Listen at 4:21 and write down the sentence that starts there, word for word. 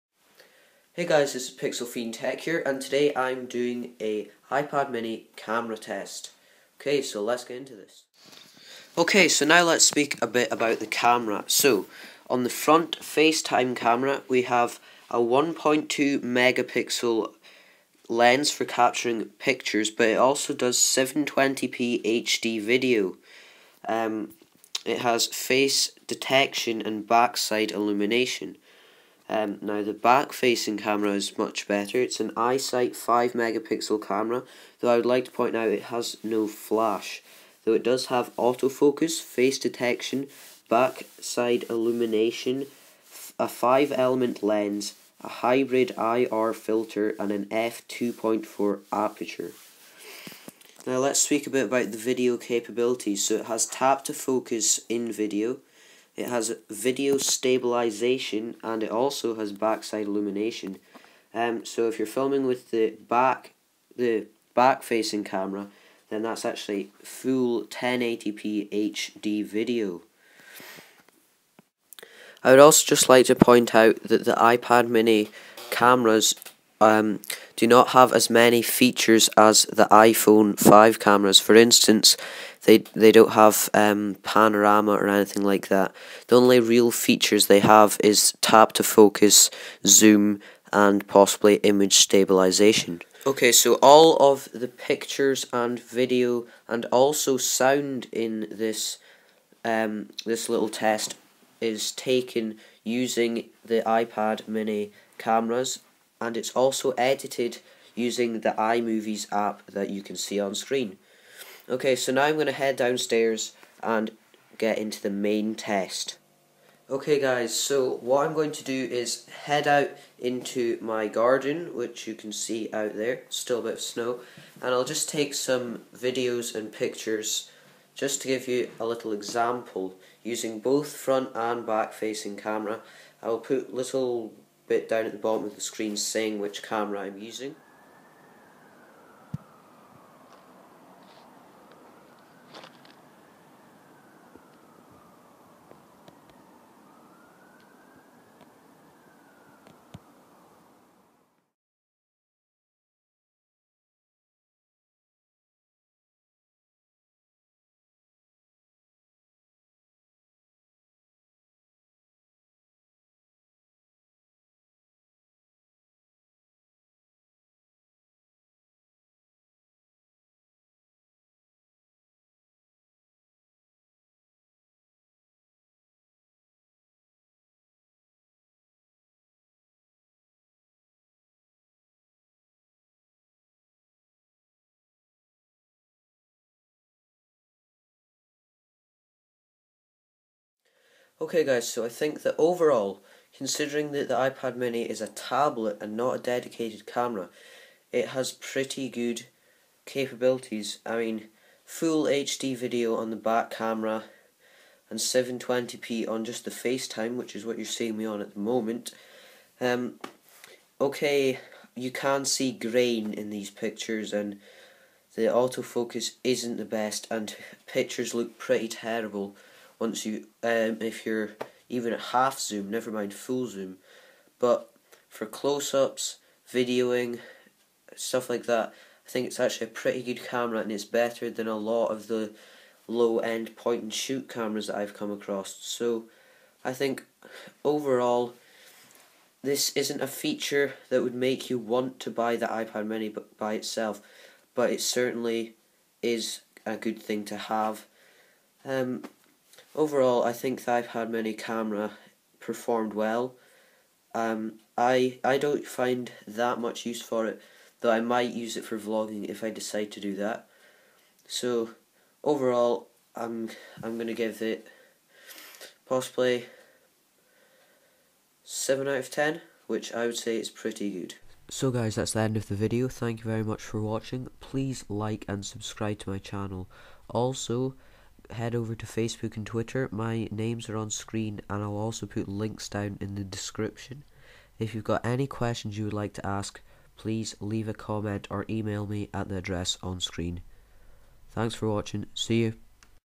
So overall, I'm I'm gonna give it possibly seven out of ten, which I would say is pretty good.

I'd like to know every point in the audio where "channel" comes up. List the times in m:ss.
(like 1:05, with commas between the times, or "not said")
4:36.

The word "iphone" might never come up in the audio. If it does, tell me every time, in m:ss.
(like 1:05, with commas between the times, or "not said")
1:19.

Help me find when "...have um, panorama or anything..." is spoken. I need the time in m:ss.
1:23.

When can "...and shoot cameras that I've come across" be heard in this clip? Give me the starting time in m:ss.
3:53.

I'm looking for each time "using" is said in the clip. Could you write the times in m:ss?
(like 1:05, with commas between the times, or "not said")
1:42, 1:47, 2:10, 2:17.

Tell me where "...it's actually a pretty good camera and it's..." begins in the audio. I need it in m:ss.
3:49.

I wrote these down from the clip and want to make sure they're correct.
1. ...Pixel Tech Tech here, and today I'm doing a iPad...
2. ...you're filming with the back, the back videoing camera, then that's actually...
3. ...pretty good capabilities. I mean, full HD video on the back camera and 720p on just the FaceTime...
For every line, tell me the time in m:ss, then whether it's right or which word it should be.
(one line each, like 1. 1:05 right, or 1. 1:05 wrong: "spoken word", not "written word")
1. 0:01 wrong: "Fiend", not "Tech"
2. 1:01 wrong: "facing", not "videoing"
3. 3:18 right.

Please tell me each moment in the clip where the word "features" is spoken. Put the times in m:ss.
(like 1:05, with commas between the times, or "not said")
1:18, 1:26, 4:00.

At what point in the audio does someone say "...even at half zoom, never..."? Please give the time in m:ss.
3:41.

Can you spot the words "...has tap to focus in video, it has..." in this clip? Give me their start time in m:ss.
0:53.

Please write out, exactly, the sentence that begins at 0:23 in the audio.
Um, it has face detection and backside illumination.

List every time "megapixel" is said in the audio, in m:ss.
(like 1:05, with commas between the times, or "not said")
0:16, 0:33.